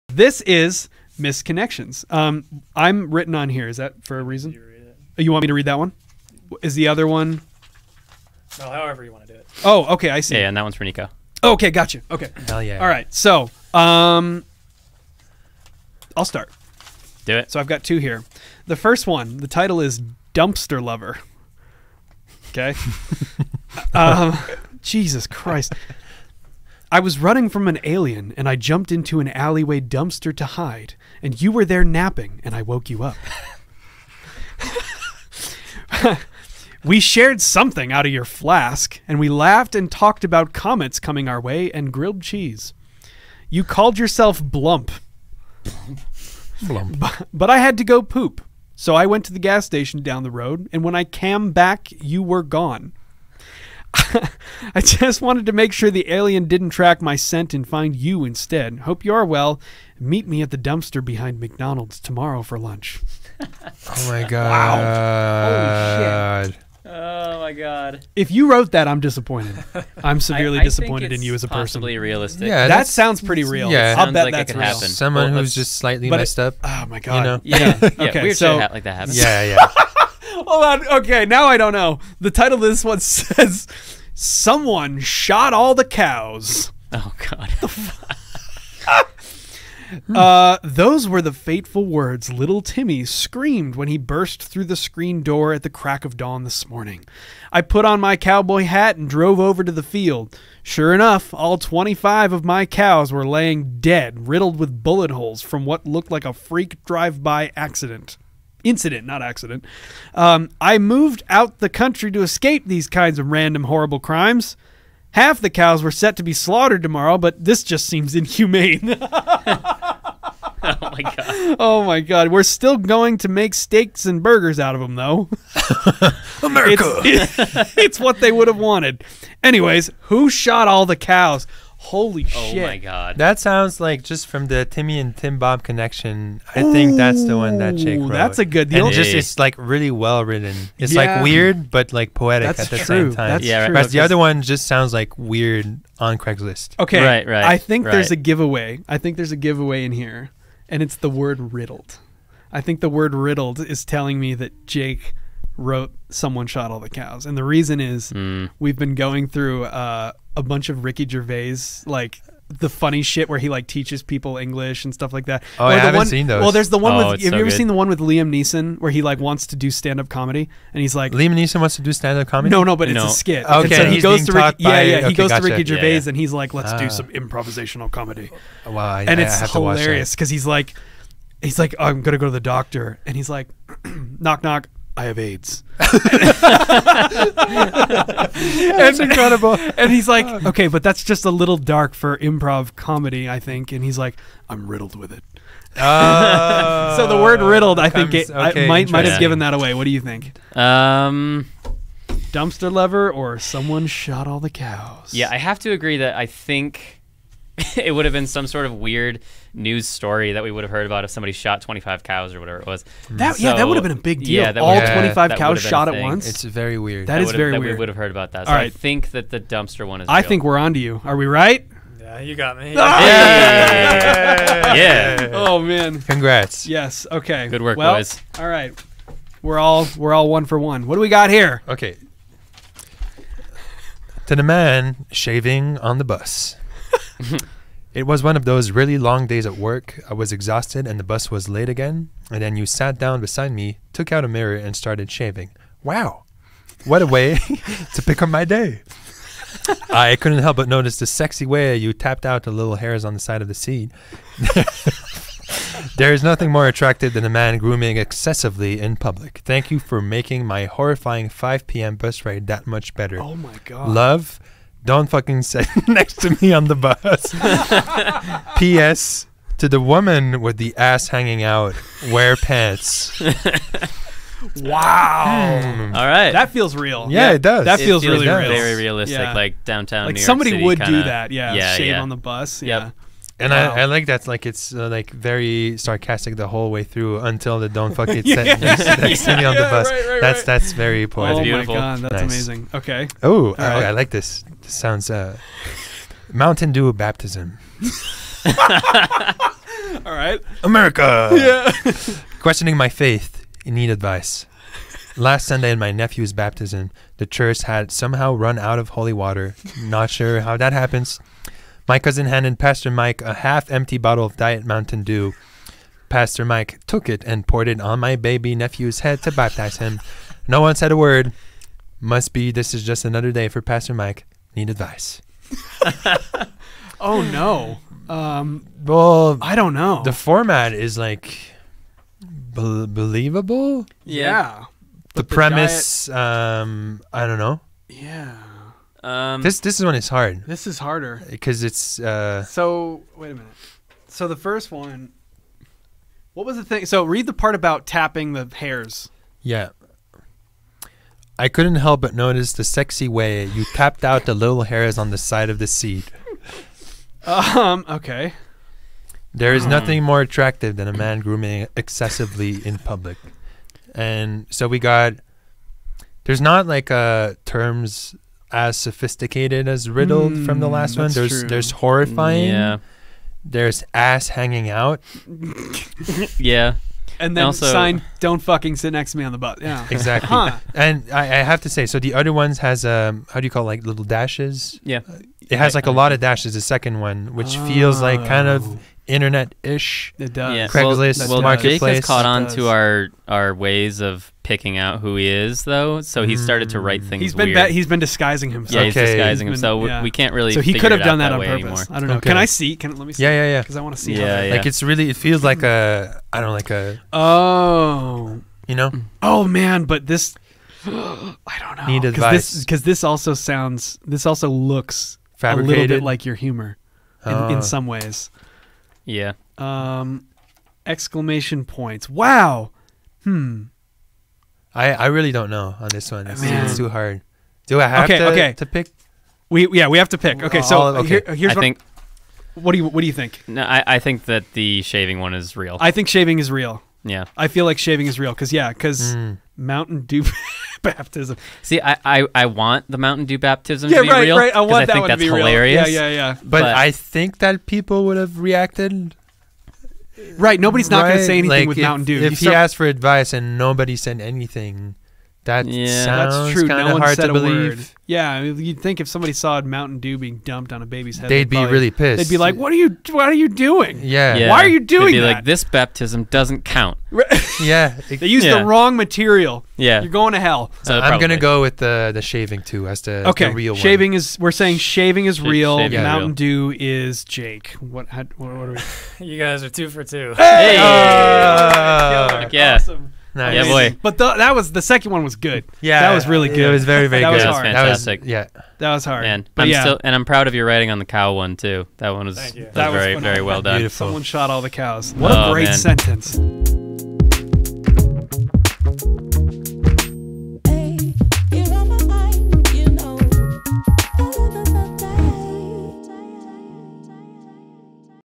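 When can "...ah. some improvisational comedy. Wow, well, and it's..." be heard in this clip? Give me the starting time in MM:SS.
02:56.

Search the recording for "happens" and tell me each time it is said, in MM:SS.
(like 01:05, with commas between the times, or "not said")
01:14, 01:18, 05:10.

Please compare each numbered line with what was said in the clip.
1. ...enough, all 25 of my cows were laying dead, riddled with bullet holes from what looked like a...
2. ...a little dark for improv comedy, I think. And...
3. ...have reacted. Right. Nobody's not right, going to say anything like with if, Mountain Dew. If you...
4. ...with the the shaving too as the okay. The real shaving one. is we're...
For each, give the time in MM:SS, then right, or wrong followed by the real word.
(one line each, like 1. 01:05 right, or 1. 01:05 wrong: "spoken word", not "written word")
1. 01:40 right
2. 03:11 right
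3. 07:28 right
4. 07:51 right.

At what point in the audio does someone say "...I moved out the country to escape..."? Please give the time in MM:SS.
01:50.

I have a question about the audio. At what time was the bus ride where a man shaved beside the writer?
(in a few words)
5 p.m.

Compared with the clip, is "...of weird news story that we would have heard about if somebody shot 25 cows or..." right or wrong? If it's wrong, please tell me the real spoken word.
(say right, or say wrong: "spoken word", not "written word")
right.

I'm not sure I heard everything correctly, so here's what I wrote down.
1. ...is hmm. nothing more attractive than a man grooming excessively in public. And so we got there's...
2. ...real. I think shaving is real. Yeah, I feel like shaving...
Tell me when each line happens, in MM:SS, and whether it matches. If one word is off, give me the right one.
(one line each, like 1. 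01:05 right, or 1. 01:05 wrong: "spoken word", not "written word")
1. 05:59 right
2. 07:15 right.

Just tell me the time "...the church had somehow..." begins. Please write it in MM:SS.
05:07.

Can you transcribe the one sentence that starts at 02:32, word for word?
I think the word riddled is telling me that Jake wrote "Someone Shot All the Cows," and the reason is mm.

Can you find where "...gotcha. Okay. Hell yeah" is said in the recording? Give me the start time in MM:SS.
00:11.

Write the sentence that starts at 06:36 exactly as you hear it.
So he started to write mm.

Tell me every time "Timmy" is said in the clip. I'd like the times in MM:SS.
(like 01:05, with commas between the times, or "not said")
01:32, 02:14.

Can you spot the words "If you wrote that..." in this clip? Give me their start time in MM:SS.
01:08.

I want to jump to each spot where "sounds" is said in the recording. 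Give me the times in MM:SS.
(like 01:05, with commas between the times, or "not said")
01:12, 02:13, 02:24, 04:54, 06:53.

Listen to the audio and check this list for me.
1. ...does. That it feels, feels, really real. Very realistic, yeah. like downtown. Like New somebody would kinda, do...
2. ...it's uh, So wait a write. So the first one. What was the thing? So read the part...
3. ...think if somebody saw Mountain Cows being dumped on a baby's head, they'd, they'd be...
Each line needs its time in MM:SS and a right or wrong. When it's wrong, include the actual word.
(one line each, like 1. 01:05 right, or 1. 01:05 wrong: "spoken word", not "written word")
1. 04:37 right
2. 05:41 wrong: "minute", not "write"
3. 07:38 wrong: "Dew", not "Cows".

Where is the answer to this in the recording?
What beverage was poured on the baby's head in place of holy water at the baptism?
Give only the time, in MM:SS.
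05:14.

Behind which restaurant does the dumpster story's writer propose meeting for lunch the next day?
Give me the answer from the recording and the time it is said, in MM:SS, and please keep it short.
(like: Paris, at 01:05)
McDonald's, at 01:01.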